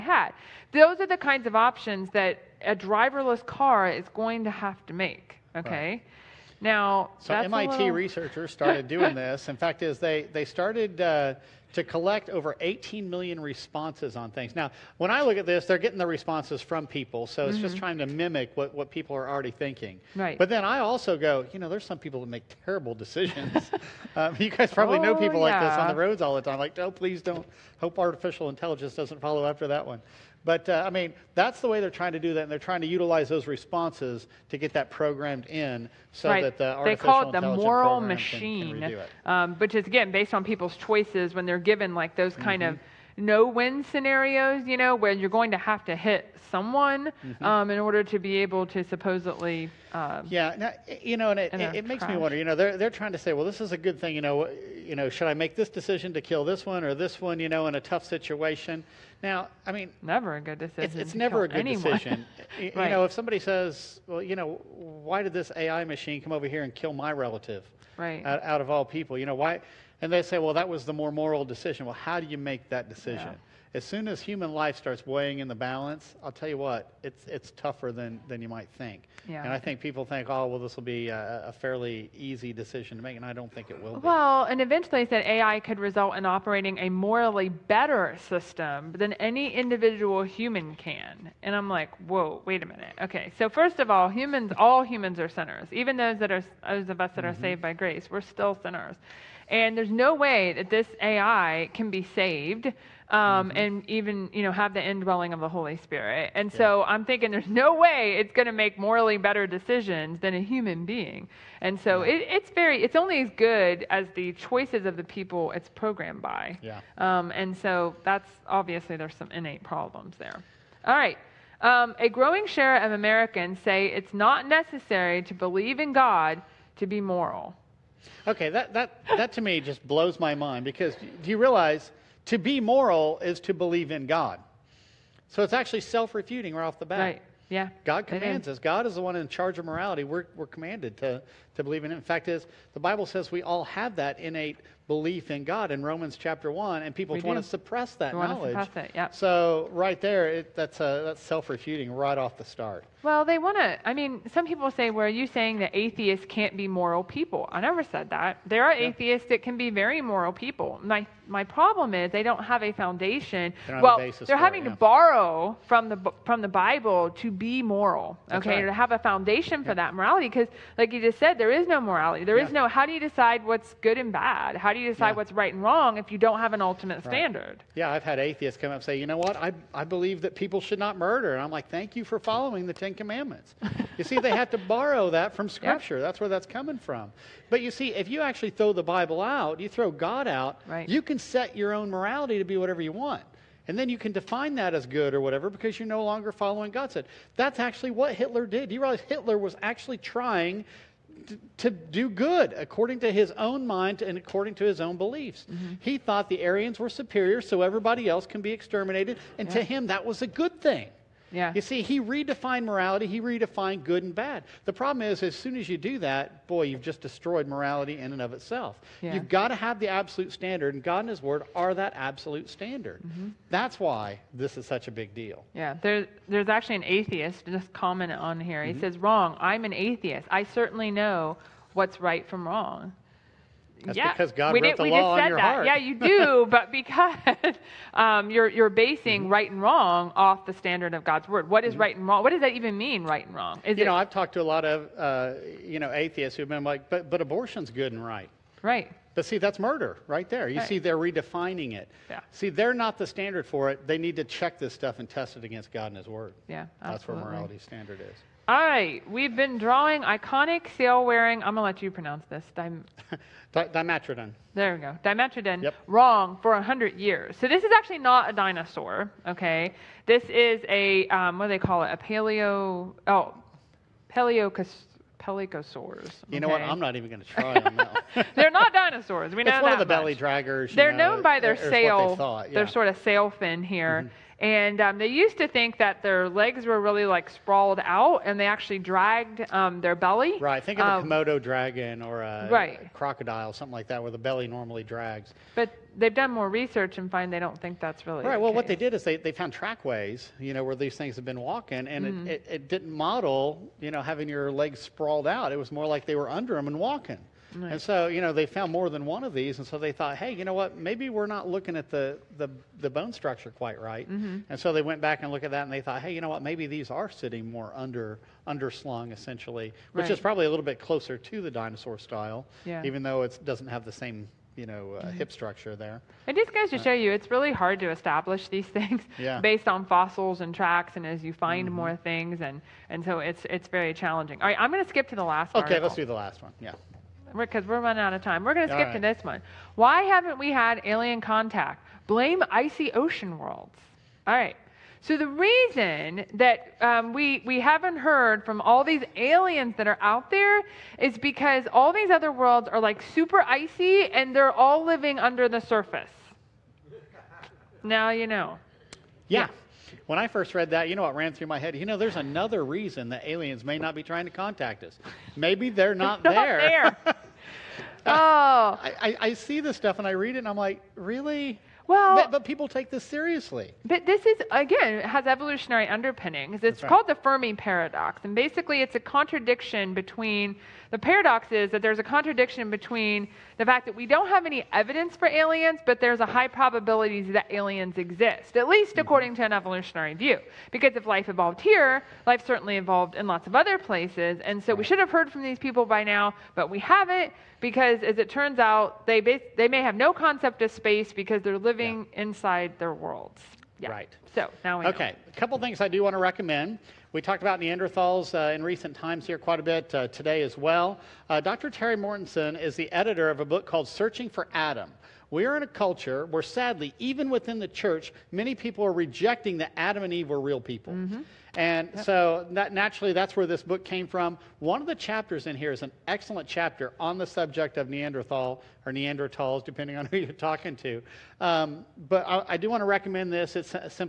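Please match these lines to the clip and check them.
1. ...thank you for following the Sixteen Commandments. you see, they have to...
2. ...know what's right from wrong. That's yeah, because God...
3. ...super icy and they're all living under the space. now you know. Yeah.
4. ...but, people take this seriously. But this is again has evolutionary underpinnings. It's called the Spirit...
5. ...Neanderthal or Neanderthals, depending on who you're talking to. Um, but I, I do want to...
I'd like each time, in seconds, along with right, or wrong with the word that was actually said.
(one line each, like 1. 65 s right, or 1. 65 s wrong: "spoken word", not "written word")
1. 181 s wrong: "Ten", not "Sixteen"
2. 230 s right
3. 353 s wrong: "surface", not "space"
4. 372 s wrong: "Fermi", not "Spirit"
5. 427 s right.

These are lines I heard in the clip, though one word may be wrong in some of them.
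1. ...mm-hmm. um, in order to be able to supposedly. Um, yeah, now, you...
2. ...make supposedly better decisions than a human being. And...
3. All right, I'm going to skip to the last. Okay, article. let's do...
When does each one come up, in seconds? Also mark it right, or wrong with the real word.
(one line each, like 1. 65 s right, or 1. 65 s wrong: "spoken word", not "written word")
1. 47 s right
2. 108 s wrong: "morally", not "supposedly"
3. 334 s right.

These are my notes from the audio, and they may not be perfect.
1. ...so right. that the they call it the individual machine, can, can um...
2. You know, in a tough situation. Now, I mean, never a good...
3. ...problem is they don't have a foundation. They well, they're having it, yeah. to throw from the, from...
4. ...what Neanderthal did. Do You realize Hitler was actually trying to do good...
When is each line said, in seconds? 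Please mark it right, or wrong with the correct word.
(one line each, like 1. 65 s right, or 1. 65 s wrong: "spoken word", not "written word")
1. 36 s wrong: "moral", not "individual"
2. 57 s right
3. 161 s wrong: "borrow", not "throw"
4. 197 s wrong: "Hitler", not "Neanderthal".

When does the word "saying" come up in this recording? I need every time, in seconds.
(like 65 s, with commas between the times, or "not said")
155 s.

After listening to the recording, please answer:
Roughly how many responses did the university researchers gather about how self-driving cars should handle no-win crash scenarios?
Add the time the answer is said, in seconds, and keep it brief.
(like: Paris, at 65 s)
18 million, at 12 s.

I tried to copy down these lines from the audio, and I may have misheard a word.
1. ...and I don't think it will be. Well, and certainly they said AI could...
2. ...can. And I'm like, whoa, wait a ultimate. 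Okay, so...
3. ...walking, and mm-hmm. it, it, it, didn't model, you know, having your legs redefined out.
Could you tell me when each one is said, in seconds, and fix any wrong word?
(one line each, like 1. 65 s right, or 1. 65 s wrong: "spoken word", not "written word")
1. 83 s wrong: "eventually", not "certainly"
2. 90 s wrong: "minute", not "ultimate"
3. 301 s wrong: "sprawled", not "redefined".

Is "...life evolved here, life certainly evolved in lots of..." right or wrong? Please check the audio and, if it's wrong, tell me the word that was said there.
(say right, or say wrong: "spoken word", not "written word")
right.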